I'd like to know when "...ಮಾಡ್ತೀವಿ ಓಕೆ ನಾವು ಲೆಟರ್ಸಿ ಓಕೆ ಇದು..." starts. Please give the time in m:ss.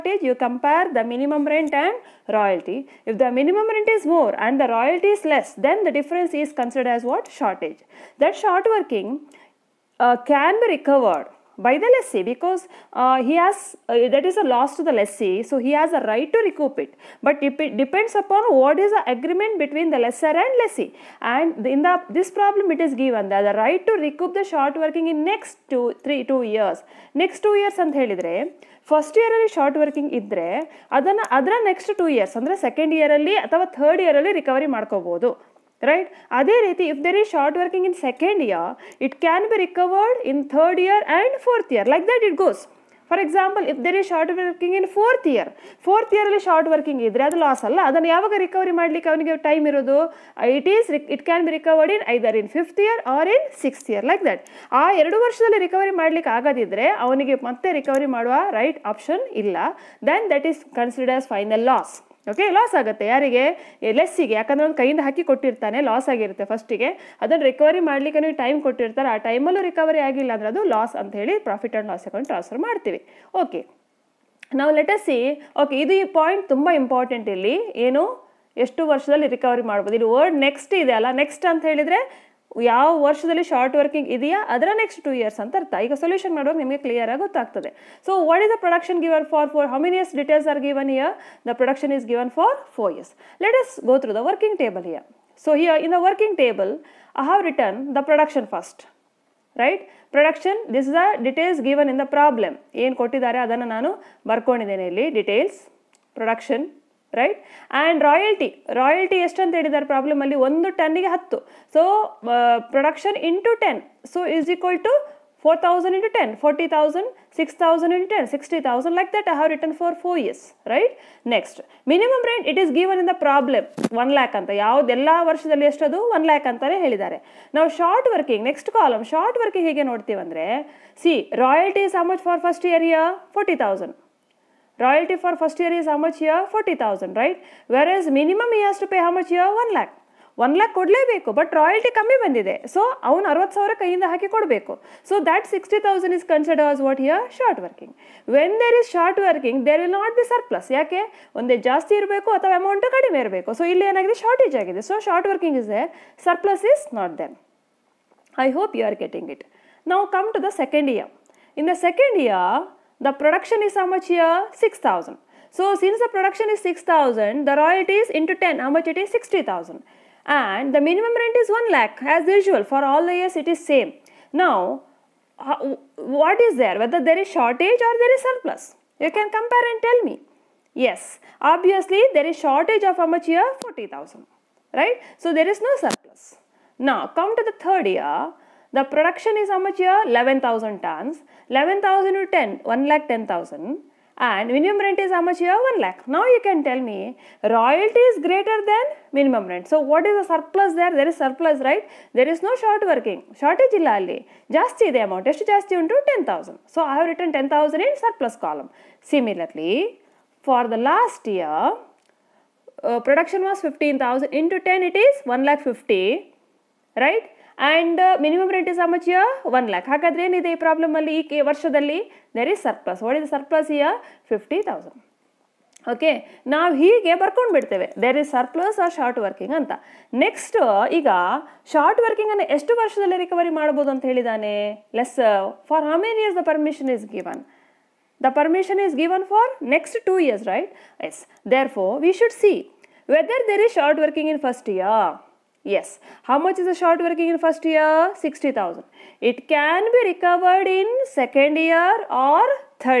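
1:12.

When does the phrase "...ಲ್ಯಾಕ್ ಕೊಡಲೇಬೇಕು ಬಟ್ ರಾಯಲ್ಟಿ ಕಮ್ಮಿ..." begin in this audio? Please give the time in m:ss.
2:20.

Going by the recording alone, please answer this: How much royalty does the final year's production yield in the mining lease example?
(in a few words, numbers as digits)
1 lakh 50.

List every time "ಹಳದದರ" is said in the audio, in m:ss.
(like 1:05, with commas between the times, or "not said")
1:49, 2:06.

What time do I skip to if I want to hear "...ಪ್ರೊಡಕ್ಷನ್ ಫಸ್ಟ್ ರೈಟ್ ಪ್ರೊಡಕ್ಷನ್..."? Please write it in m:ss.
1:38.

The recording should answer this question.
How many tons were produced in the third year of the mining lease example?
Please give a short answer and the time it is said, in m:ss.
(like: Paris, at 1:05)
11,000 tons, at 3:10.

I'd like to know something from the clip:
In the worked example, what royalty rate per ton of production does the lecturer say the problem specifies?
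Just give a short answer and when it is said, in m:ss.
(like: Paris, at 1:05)
10, at 1:50.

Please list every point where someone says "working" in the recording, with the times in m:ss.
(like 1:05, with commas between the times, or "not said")
0:08, 0:24, 3:22, 4:07.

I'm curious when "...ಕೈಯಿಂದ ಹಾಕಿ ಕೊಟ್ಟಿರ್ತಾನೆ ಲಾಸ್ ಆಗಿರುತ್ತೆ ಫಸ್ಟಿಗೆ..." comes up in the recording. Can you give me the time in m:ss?
1:04.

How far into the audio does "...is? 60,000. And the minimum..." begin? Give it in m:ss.
2:48.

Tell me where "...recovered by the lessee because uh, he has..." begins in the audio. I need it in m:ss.
0:10.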